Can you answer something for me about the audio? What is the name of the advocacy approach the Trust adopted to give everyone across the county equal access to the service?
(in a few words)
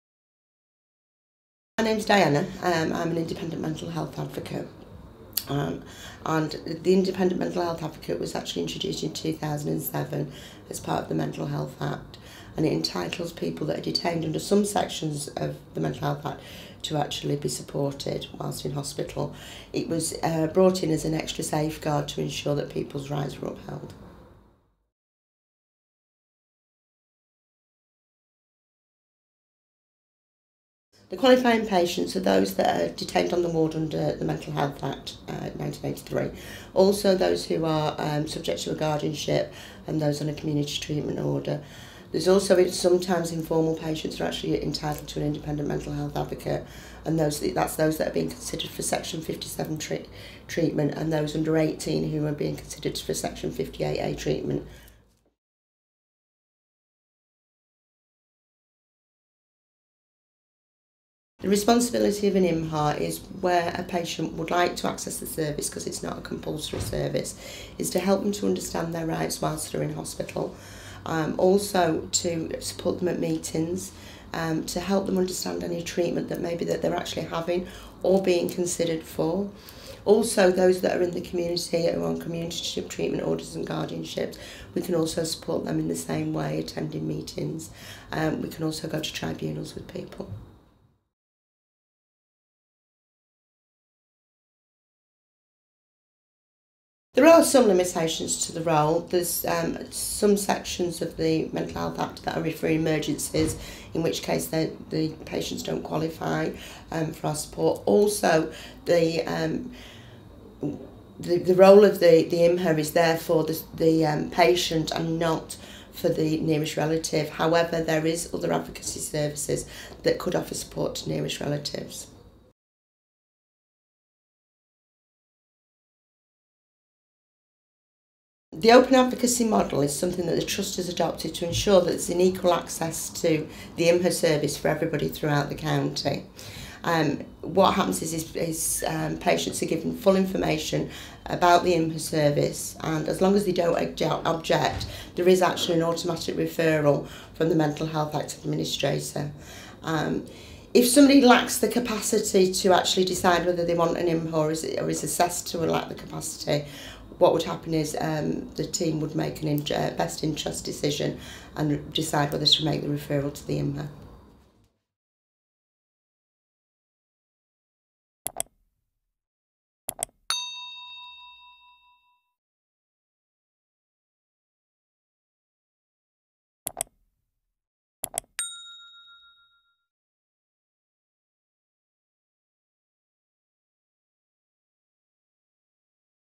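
Open advocacy model.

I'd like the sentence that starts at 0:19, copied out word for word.
It was uh, brought in as an extra safeguard to ensure that people's rights were upheld.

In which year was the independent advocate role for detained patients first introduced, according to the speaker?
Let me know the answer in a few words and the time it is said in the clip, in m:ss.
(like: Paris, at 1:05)
2007, at 0:09.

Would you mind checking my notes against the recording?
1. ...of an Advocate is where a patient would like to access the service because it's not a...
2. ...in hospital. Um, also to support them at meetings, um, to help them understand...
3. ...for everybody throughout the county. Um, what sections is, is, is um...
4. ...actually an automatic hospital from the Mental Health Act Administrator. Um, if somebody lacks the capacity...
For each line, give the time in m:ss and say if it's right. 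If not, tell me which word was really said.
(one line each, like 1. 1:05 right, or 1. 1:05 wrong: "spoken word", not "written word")
1. 1:02 wrong: "IMHA", not "Advocate"
2. 1:09 right
3. 2:14 wrong: "happens", not "sections"
4. 2:25 wrong: "referral", not "hospital".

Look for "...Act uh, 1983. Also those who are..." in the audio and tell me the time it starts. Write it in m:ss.
0:34.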